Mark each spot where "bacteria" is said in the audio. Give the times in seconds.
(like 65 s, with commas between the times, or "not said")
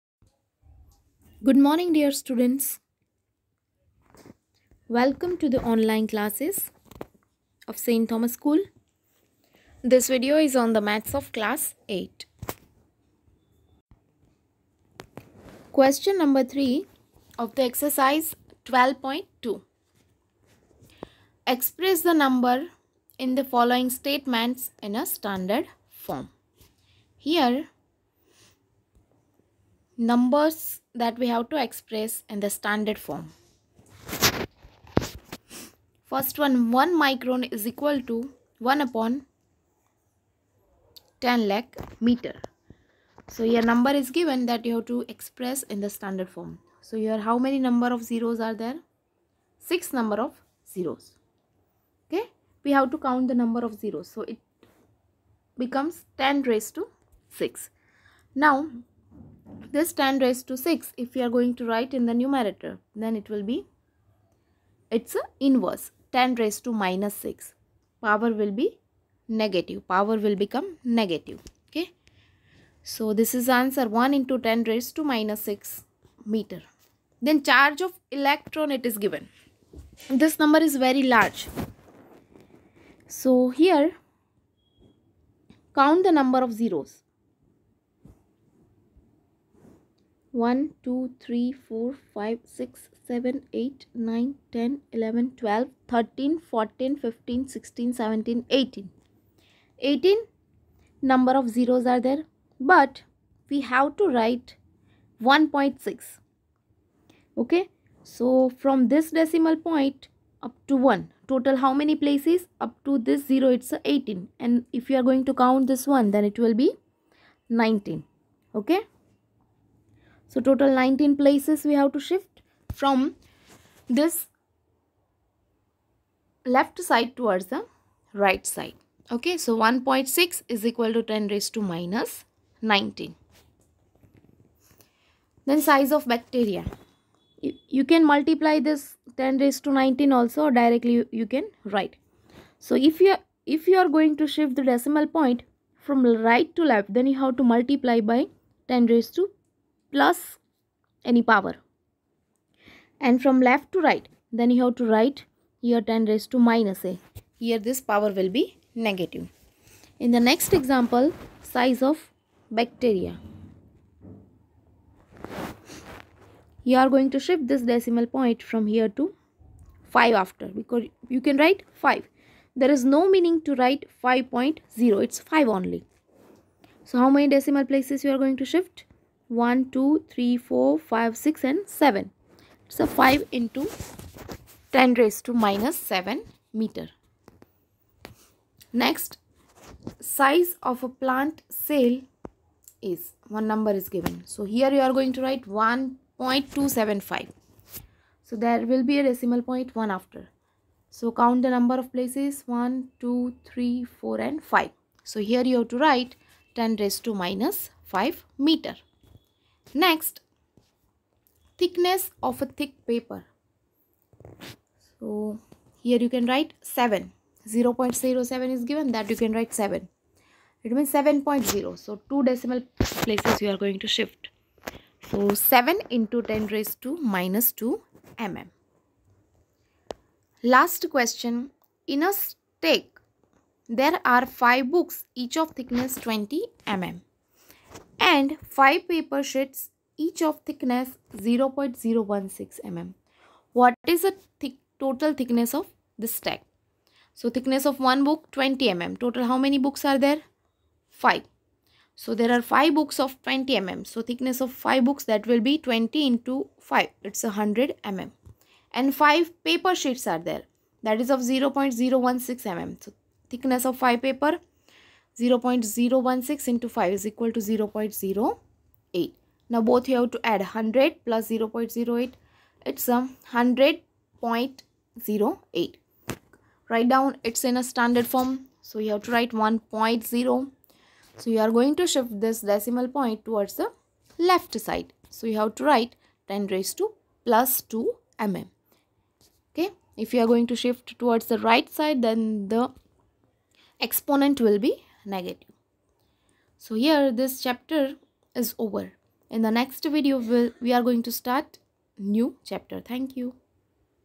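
136 s, 162 s.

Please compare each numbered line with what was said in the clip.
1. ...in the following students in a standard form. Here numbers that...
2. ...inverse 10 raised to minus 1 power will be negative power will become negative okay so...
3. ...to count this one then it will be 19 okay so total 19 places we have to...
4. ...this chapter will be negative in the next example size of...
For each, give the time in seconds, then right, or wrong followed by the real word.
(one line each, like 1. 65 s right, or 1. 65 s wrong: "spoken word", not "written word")
1. 23 s wrong: "statements", not "students"
2. 65 s wrong: "6", not "1"
3. 115 s right
4. 157 s wrong: "power", not "chapter".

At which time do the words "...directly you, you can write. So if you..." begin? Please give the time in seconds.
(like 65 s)
140 s.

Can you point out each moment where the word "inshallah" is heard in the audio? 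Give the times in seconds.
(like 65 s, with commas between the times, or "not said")
not said.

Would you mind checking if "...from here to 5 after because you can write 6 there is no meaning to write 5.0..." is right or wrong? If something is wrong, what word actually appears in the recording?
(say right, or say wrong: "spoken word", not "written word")
wrong: "5", not "6".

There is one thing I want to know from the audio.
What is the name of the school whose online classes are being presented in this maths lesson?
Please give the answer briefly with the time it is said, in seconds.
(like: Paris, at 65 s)
St. Thomas School, at 7 s.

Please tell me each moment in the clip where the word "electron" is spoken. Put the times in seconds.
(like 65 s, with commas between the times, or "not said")
78 s.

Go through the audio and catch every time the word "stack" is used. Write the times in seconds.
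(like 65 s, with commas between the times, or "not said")
232 s, 246 s.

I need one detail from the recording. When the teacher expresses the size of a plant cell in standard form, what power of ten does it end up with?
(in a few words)
10^-5.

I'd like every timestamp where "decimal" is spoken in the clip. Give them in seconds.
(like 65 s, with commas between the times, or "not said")
109 s, 144 s, 167 s, 177 s, 199 s, 222 s, 282 s.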